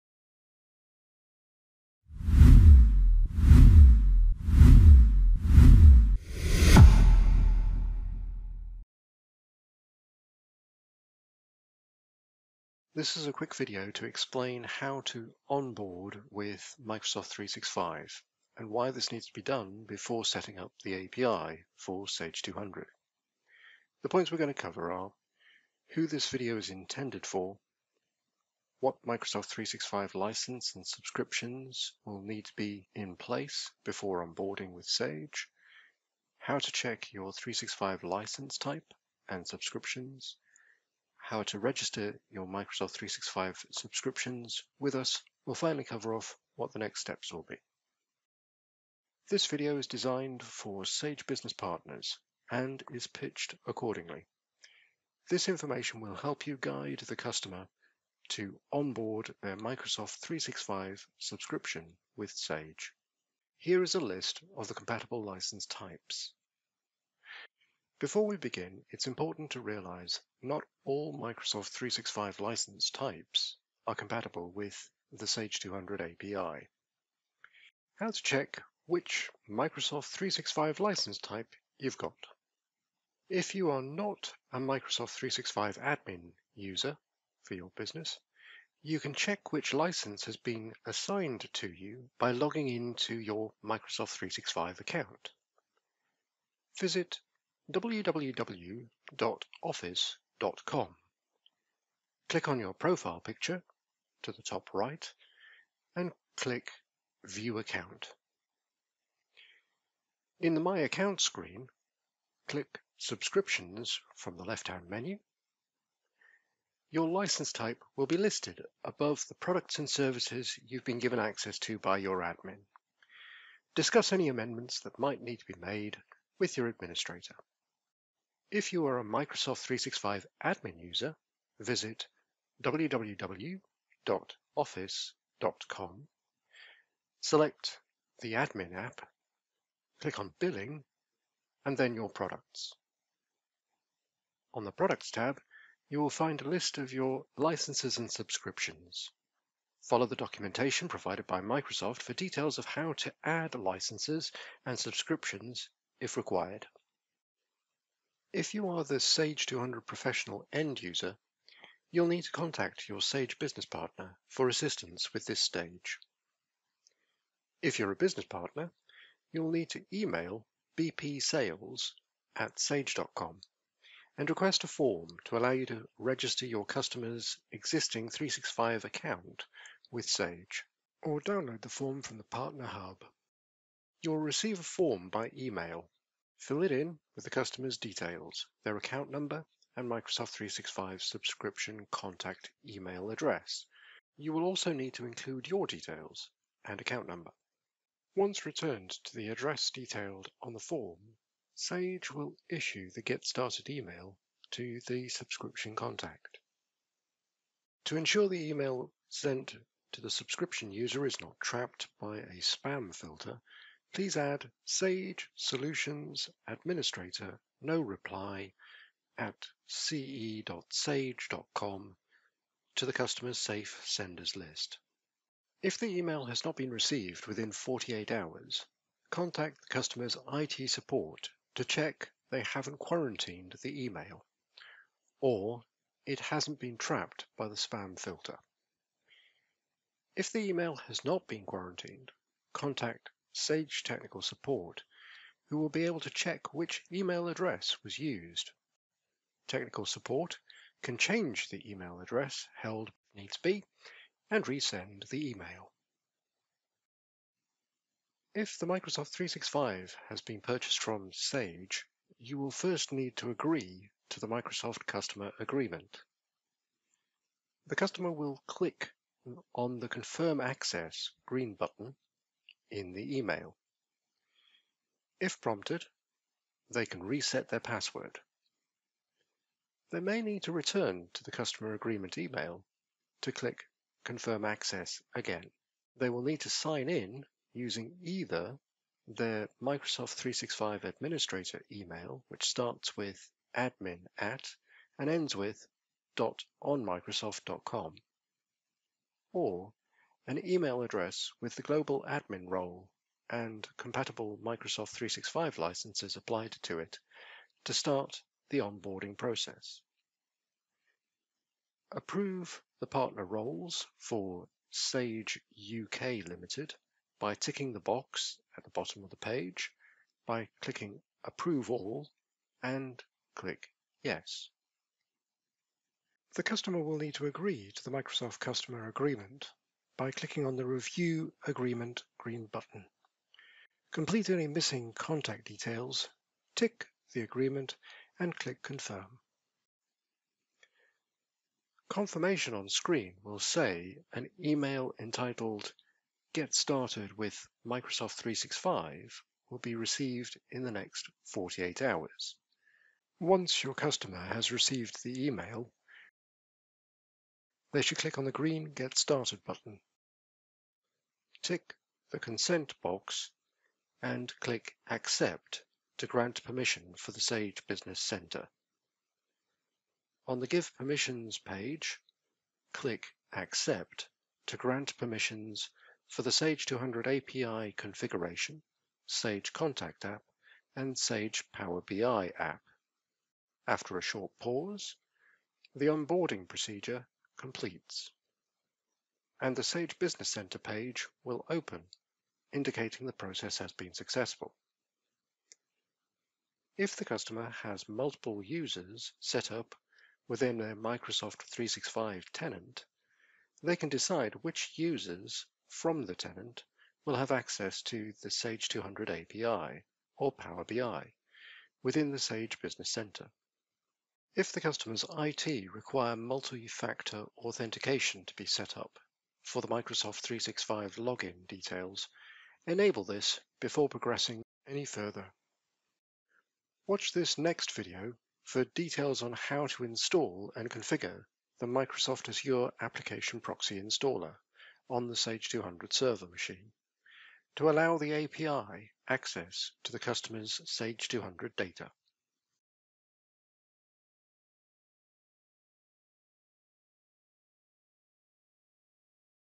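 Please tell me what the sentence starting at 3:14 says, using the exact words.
You will also need to include your details and account number.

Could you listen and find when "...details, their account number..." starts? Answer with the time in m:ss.
3:07.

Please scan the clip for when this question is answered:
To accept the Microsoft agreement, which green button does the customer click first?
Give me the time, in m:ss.
5:30.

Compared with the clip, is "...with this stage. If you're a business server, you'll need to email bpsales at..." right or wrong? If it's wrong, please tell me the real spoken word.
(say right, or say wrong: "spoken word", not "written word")
wrong: "partner", not "server".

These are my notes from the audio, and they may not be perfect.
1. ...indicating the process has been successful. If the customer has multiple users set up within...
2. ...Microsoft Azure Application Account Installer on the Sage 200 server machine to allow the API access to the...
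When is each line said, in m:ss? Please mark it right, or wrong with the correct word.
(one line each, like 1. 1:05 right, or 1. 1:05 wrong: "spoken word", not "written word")
1. 6:32 right
2. 7:11 wrong: "Proxy", not "Account".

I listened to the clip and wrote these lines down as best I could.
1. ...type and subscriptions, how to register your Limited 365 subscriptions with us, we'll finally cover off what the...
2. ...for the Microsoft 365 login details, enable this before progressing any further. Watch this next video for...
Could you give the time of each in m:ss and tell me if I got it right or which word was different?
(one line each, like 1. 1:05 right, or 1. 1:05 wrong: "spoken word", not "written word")
1. 0:38 wrong: "Microsoft", not "Limited"
2. 6:59 right.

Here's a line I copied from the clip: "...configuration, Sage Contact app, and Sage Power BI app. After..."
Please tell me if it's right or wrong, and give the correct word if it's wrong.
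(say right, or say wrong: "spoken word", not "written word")
right.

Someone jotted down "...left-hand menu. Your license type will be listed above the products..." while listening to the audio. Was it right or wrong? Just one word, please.
right.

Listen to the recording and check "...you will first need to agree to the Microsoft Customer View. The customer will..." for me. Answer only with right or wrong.
wrong.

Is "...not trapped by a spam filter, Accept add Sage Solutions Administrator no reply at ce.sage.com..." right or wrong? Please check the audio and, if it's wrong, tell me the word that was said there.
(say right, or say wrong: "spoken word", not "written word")
wrong: "Please", not "Accept".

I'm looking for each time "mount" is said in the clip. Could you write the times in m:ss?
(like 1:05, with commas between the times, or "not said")
not said.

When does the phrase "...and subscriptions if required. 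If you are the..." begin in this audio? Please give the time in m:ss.
2:34.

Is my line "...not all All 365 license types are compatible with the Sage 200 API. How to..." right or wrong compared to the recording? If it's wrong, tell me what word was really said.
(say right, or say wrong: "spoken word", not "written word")
wrong: "Microsoft", not "All".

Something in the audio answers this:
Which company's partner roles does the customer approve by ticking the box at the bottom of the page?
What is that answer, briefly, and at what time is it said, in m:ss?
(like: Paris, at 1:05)
Sage UK Limited, at 5:14.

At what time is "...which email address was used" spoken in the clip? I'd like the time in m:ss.
4:06.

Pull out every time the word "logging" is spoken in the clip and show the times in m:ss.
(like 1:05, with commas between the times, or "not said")
1:32.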